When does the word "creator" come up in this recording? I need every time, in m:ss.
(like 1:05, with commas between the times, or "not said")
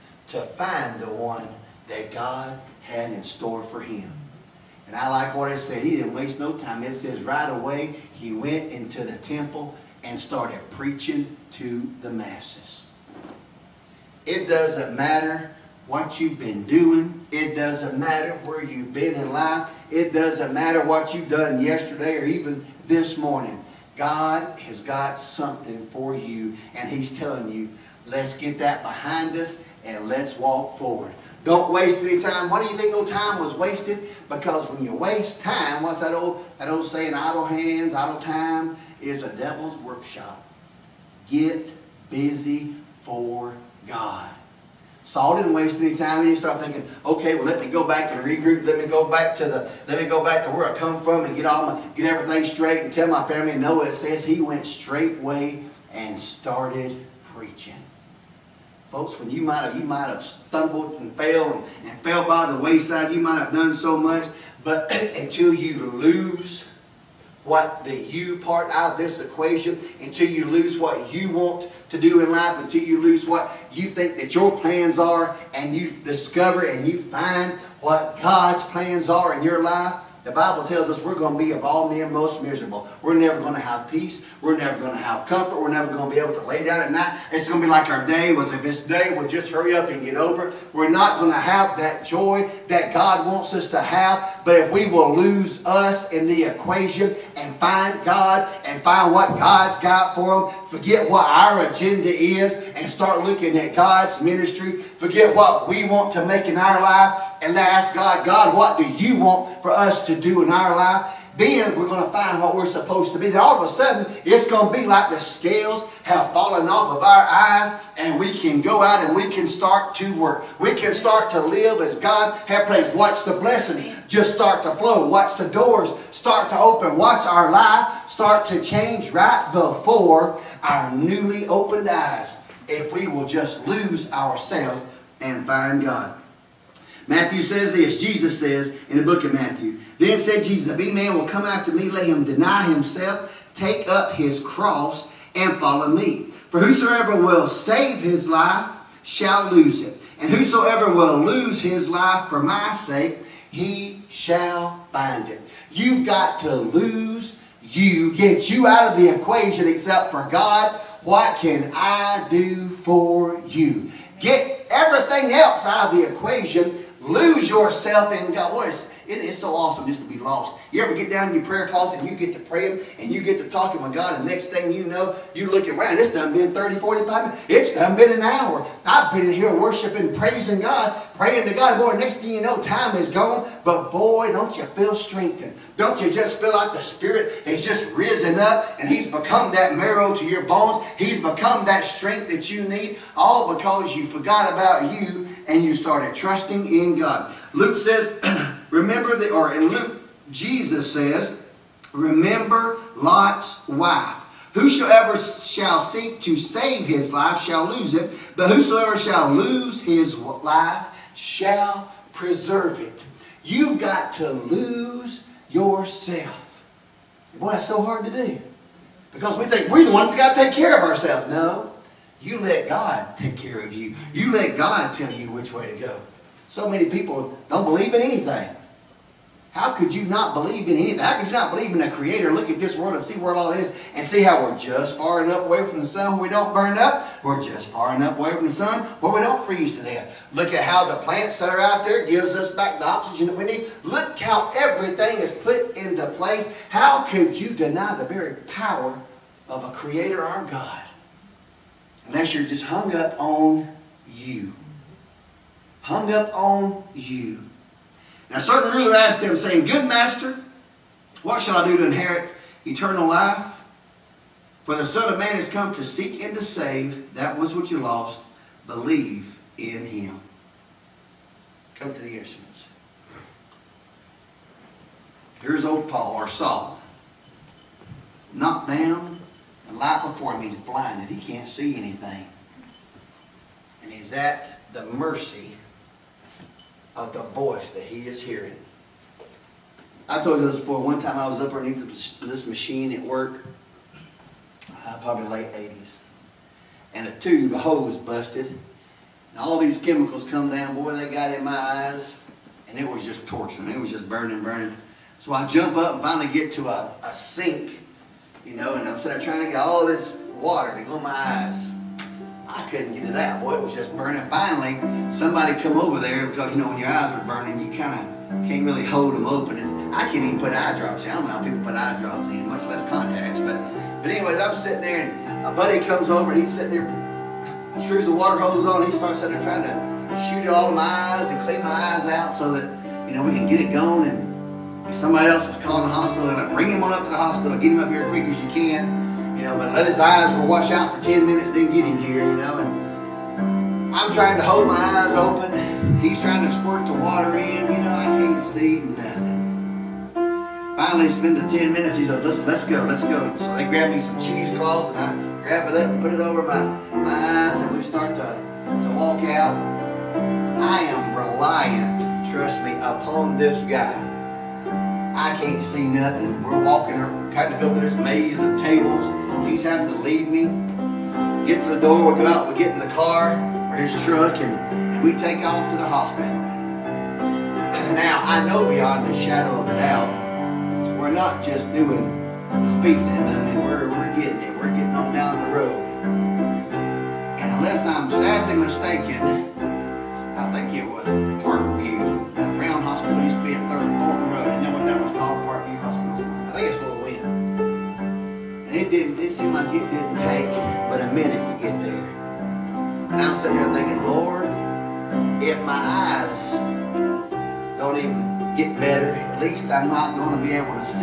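3:51, 4:09.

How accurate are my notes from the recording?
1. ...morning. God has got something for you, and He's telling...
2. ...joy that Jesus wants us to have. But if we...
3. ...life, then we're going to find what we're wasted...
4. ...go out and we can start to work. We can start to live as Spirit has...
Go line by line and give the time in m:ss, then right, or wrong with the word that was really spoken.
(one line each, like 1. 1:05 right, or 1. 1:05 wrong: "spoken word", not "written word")
1. 0:23 right
2. 1:32 wrong: "God", not "Jesus"
3. 1:50 wrong: "supposed", not "wasted"
4. 1:58 wrong: "God", not "Spirit".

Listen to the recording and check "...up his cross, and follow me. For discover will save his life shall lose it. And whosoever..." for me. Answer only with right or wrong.
wrong.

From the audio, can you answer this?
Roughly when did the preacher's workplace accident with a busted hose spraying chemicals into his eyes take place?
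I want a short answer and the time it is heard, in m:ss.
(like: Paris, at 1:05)
late 80s, at 4:55.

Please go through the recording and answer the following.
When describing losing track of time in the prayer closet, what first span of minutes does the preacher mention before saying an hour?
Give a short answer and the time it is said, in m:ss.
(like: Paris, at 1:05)
30, 45 minutes, at 2:56.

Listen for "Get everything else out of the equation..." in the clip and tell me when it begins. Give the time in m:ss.
2:44.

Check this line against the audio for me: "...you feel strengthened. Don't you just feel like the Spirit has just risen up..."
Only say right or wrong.
right.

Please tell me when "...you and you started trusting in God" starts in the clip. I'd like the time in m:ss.
3:15.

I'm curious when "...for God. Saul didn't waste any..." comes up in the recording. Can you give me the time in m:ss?
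0:43.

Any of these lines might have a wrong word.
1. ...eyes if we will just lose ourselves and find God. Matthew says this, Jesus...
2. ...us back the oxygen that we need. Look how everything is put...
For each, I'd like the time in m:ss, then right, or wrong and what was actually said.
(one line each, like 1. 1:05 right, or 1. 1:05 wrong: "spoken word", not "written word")
1. 2:11 right
2. 4:02 right.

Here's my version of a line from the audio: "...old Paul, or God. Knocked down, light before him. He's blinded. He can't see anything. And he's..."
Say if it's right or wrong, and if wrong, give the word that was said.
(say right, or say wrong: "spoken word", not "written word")
wrong: "Saul", not "God".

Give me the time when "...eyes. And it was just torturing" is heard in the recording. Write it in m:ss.
5:01.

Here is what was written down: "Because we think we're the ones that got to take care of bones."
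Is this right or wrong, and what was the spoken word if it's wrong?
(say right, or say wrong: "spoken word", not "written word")
wrong: "ourselves", not "bones".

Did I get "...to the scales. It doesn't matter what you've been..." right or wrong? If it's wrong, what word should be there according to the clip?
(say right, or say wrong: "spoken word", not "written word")
wrong: "masses", not "scales".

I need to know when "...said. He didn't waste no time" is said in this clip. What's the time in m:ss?
0:05.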